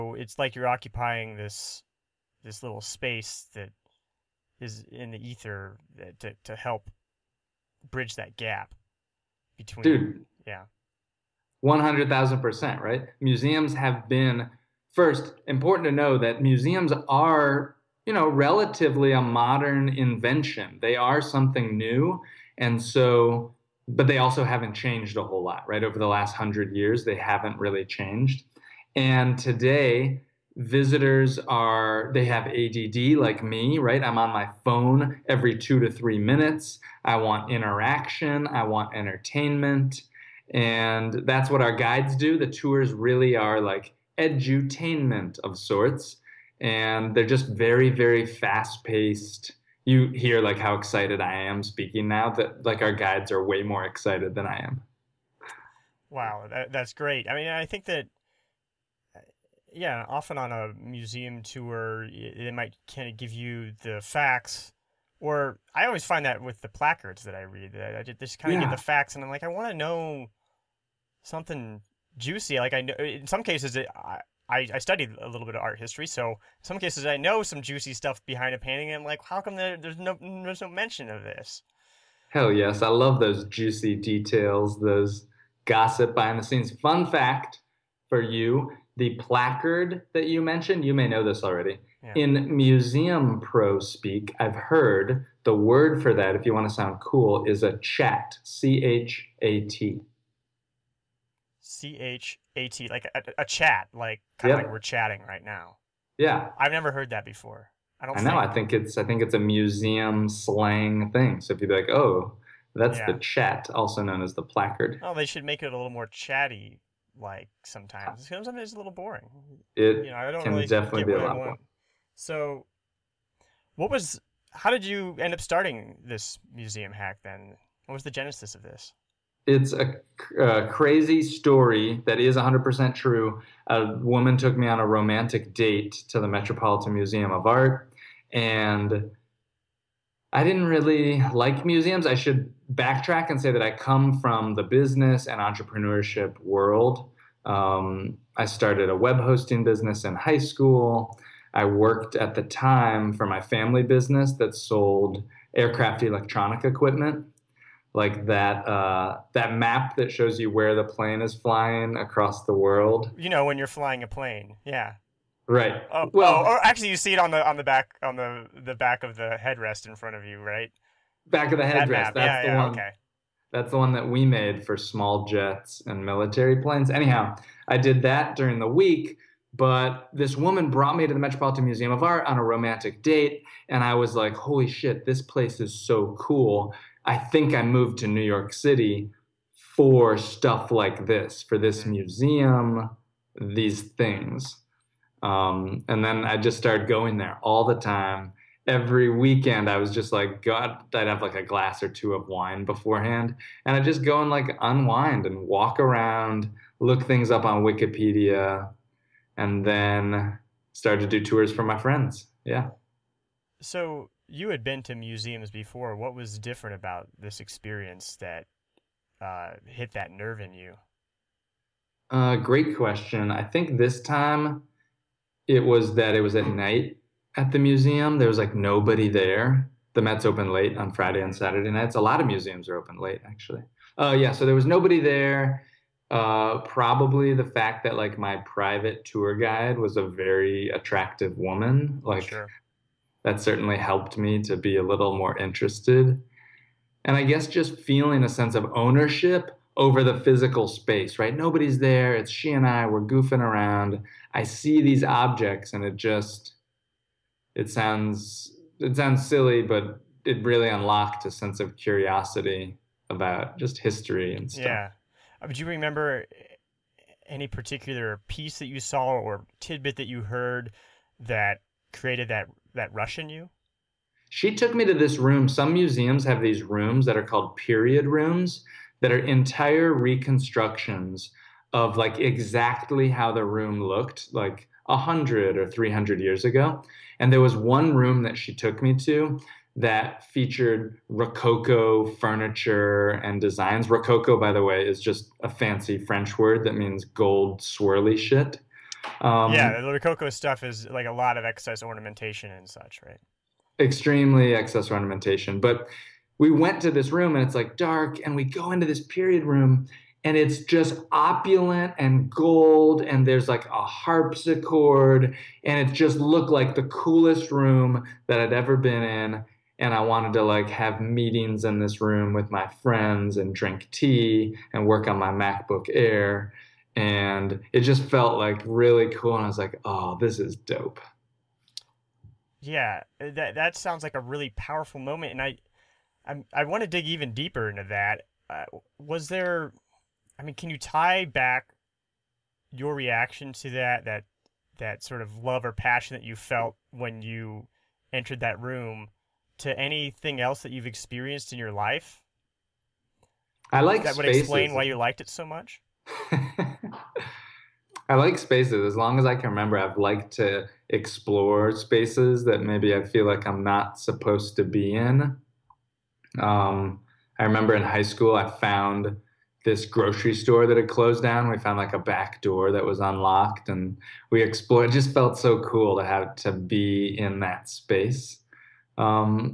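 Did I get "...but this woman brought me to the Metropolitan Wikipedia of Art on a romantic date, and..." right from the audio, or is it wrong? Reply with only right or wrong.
wrong.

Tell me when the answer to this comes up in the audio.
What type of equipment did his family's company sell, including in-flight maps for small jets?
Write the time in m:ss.
2:35.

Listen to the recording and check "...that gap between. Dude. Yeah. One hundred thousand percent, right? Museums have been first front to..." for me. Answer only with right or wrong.
wrong.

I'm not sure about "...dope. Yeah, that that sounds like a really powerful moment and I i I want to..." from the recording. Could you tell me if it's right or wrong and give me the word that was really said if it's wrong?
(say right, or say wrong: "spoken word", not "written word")
right.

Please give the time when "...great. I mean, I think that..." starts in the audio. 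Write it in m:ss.
0:56.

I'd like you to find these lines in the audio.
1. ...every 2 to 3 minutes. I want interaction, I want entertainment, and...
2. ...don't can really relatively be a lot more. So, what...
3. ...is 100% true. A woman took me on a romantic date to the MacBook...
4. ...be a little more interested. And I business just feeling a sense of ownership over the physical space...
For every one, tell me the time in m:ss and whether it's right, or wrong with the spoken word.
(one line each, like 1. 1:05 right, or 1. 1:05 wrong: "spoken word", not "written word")
1. 0:35 right
2. 2:00 wrong: "definitely", not "relatively"
3. 2:12 wrong: "Metropolitan", not "MacBook"
4. 4:04 wrong: "guess", not "business".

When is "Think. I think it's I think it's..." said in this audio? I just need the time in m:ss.
1:48.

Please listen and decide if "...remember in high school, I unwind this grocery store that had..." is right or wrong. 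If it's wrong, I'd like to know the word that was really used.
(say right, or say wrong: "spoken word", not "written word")
wrong: "found", not "unwind".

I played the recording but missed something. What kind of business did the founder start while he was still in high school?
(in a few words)
web hosting business.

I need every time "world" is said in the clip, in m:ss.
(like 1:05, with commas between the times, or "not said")
2:26, 2:42.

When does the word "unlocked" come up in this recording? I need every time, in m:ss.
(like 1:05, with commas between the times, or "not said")
4:20, 6:12.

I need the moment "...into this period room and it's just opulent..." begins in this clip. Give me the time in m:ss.
5:08.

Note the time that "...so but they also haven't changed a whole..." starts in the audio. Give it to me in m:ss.
0:22.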